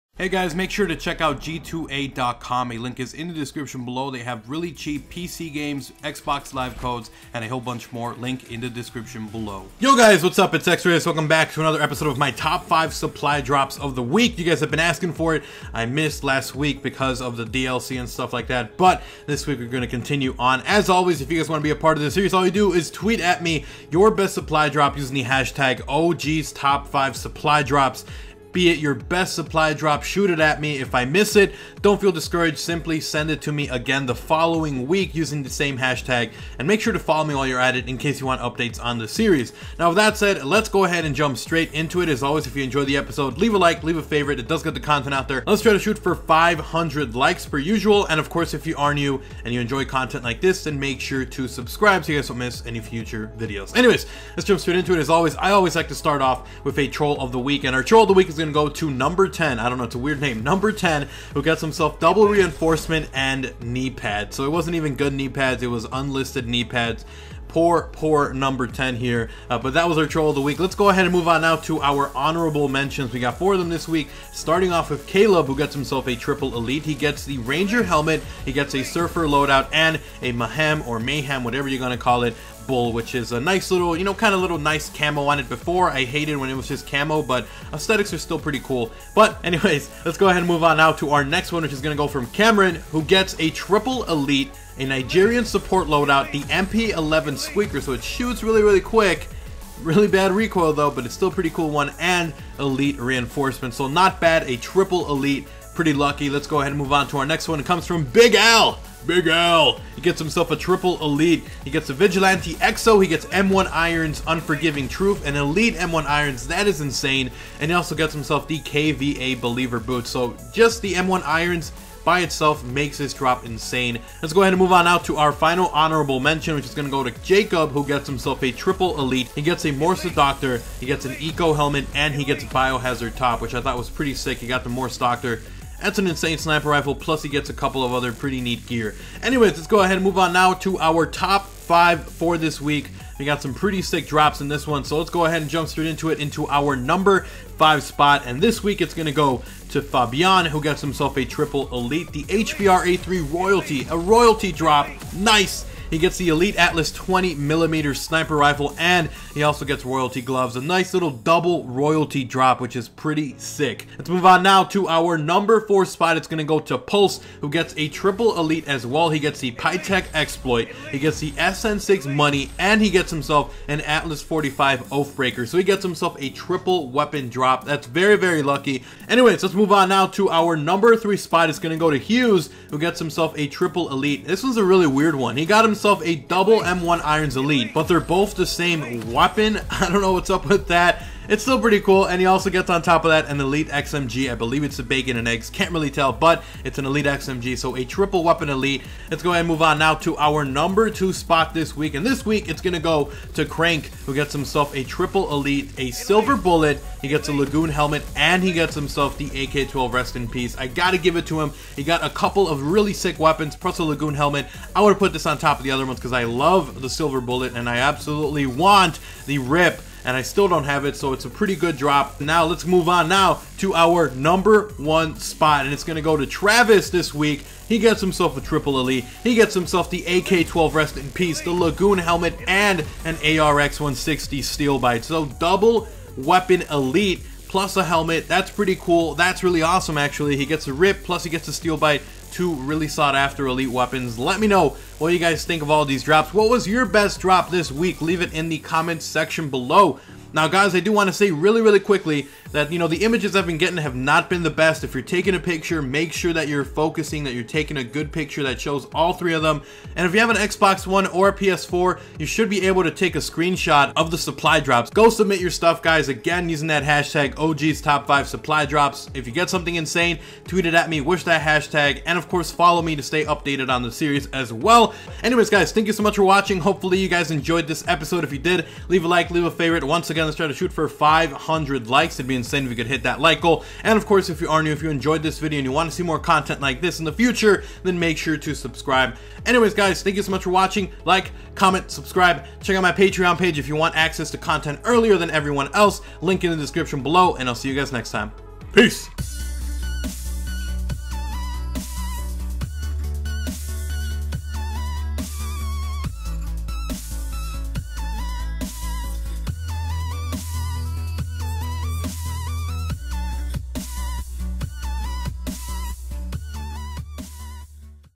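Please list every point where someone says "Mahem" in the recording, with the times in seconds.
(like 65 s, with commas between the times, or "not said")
80 s.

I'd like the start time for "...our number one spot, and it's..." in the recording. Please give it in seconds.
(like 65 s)
223 s.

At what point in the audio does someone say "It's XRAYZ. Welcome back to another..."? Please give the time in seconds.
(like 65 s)
10 s.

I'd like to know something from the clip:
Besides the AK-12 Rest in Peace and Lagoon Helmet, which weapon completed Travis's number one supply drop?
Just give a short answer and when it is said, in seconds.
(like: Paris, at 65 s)
ARX-160 Steel Bite, at 233 s.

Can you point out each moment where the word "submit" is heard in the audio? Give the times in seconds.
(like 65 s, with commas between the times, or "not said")
265 s.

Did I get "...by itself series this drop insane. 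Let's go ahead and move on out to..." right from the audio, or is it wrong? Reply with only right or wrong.
wrong.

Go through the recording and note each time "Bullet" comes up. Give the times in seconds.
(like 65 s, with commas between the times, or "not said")
206 s, 217 s.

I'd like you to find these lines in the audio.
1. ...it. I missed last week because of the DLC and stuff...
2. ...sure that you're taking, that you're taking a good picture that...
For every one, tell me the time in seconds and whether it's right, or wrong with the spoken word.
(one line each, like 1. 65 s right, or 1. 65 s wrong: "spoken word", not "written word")
1. 15 s right
2. 256 s wrong: "focusing", not "taking".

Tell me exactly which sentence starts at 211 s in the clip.
He got a couple of really sick weapons, plus a Lagoon Helmet.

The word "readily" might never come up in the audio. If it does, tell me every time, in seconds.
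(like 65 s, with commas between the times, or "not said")
not said.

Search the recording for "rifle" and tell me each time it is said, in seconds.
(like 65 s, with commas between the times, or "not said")
136 s, 158 s.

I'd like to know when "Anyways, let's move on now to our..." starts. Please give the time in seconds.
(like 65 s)
179 s.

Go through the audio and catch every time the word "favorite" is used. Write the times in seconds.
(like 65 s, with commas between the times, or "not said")
44 s, 279 s.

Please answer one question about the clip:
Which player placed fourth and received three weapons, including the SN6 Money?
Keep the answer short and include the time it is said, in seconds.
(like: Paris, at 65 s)
Pulse, at 166 s.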